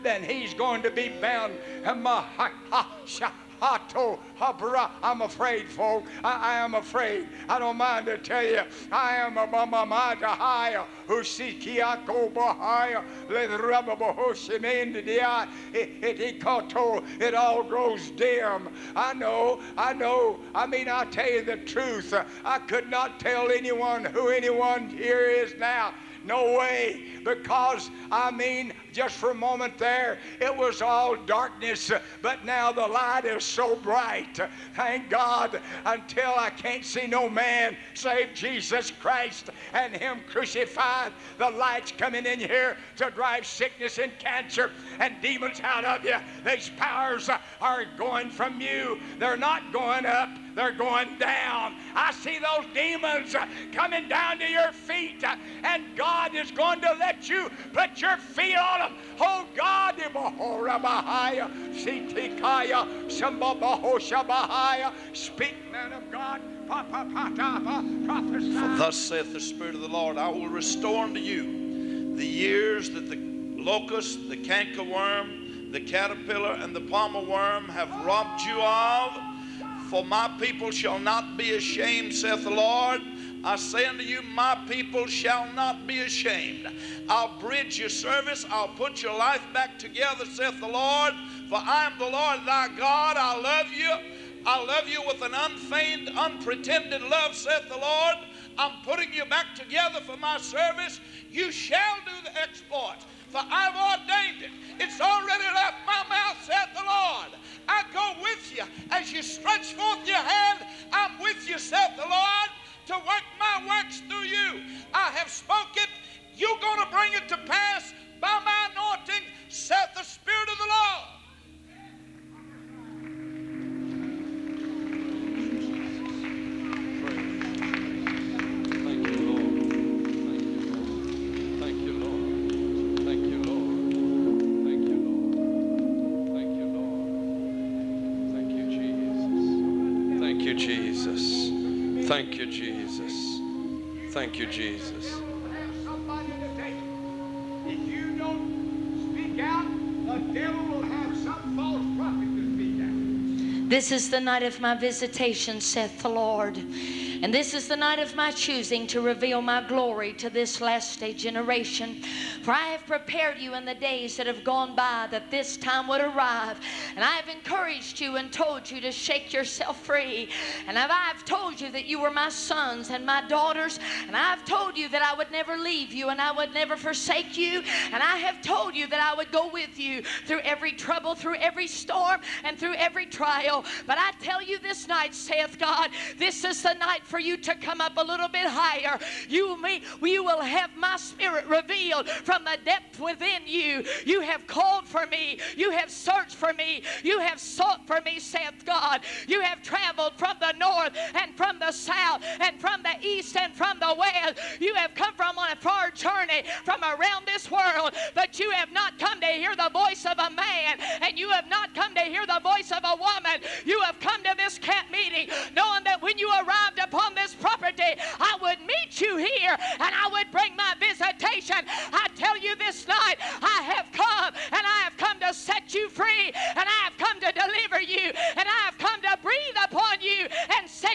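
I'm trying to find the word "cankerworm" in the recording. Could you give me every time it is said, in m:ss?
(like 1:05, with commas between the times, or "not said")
1:14.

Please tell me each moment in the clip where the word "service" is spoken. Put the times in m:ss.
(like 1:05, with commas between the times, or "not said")
1:27, 1:40.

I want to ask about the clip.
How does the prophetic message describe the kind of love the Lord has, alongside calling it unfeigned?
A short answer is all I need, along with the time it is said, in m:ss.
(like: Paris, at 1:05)
unpretended, at 1:36.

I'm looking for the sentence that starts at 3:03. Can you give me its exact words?
But I tell you this night, saith God, this is the night for you to come up a little bit higher.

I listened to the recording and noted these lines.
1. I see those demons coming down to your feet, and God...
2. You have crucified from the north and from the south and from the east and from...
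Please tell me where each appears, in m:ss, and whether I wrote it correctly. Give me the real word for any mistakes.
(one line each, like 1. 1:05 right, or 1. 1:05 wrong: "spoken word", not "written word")
1. 0:51 right
2. 3:19 wrong: "traveled", not "crucified".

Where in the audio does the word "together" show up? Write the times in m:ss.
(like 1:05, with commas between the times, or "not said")
1:29, 1:39.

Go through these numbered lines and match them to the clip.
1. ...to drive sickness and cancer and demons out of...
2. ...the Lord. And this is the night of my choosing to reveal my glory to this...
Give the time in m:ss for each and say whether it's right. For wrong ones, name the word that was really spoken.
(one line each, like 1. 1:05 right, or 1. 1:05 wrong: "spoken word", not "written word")
1. 0:42 right
2. 2:36 right.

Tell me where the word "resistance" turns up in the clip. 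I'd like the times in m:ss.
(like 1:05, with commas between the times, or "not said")
not said.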